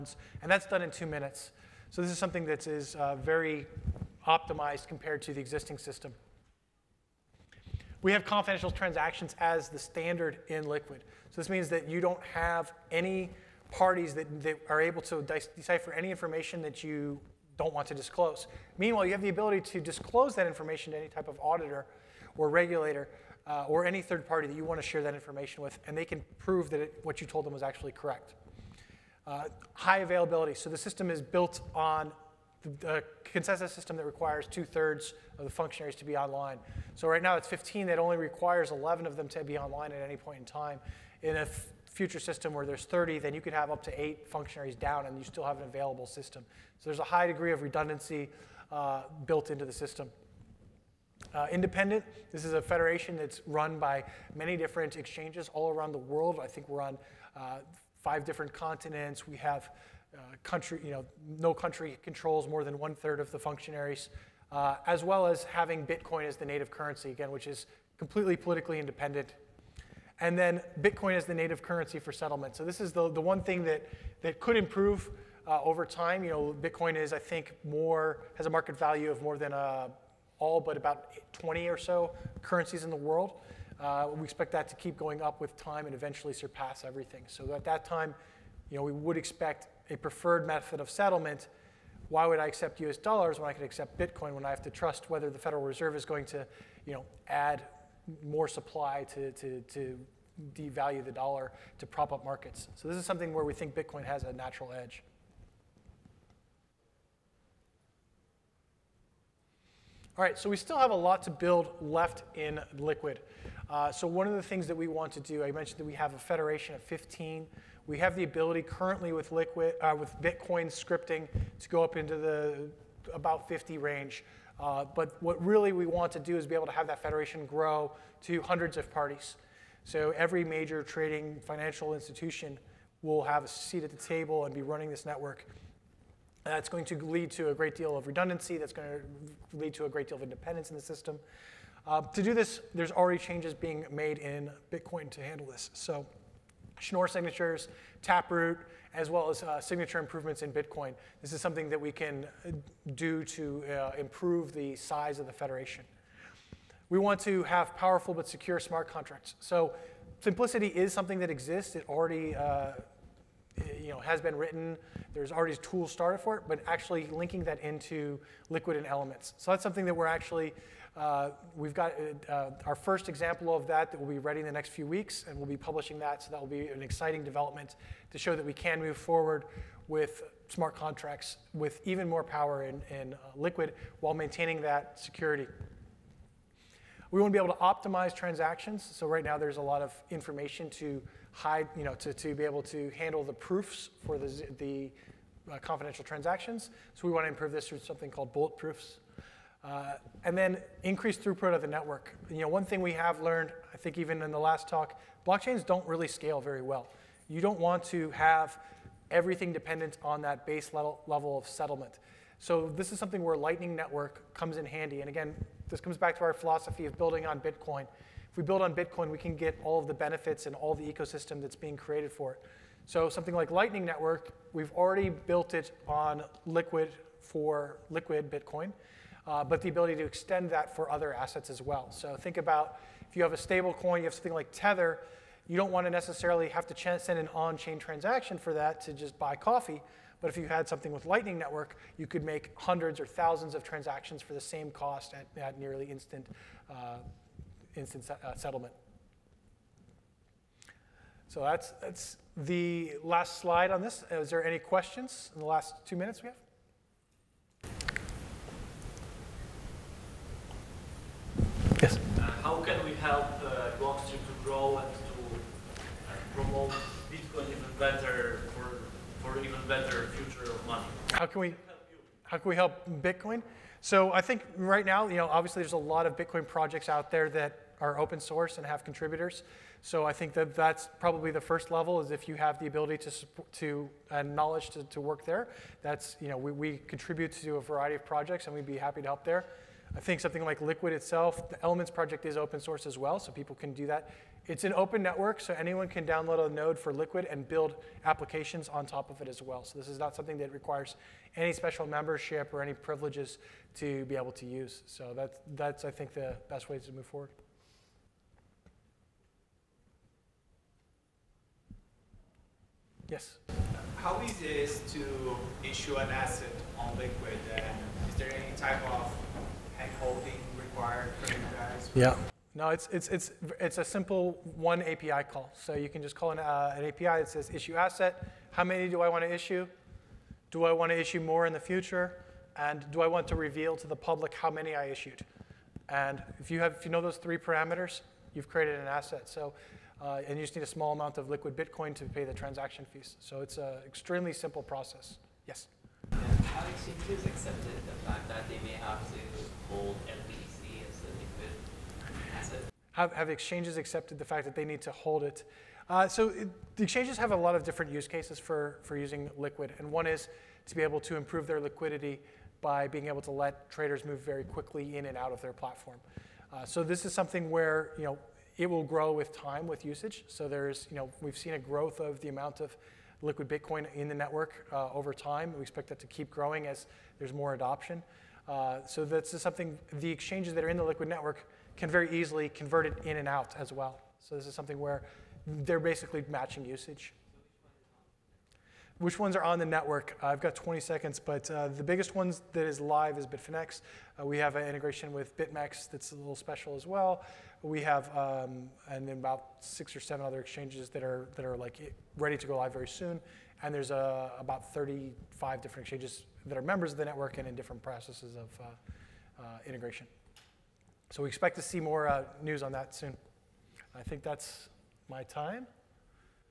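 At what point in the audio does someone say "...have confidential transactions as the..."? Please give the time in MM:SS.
00:08.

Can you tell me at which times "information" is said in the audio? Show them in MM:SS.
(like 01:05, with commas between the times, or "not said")
00:16, 00:20, 00:25, 03:10.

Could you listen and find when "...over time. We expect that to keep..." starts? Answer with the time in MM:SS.
06:14.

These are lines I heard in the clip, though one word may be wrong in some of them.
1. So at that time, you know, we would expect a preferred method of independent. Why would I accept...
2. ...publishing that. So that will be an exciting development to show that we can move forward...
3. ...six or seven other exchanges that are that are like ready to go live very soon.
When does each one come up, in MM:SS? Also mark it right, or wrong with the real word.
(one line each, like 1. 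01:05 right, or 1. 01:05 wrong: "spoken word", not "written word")
1. 01:27 wrong: "settlement", not "independent"
2. 02:55 right
3. 06:39 right.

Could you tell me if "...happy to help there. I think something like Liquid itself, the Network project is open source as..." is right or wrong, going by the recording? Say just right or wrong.
wrong.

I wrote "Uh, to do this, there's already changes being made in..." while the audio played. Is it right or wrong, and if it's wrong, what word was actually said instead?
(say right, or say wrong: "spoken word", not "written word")
right.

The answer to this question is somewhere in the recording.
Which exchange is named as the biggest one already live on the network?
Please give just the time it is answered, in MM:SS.
06:33.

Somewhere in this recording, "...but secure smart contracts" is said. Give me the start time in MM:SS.
02:38.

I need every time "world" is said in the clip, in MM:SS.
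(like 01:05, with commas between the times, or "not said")
00:55, 01:22.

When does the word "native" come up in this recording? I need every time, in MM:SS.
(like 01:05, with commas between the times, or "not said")
01:06, 01:11.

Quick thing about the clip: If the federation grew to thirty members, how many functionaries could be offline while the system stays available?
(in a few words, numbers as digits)
8.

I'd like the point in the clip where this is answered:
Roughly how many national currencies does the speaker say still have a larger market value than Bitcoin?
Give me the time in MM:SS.
01:20.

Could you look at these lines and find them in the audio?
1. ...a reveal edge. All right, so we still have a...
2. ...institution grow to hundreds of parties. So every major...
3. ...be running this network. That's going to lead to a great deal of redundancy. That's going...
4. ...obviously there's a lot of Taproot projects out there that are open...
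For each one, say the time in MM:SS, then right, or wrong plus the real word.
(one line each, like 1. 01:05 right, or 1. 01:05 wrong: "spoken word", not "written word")
1. 01:44 wrong: "natural", not "reveal"
2. 02:07 wrong: "federation", not "institution"
3. 02:14 right
4. 04:35 wrong: "Bitcoin", not "Taproot".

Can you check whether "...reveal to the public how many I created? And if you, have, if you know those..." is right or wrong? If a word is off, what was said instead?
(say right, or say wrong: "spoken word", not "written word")
wrong: "issued", not "created".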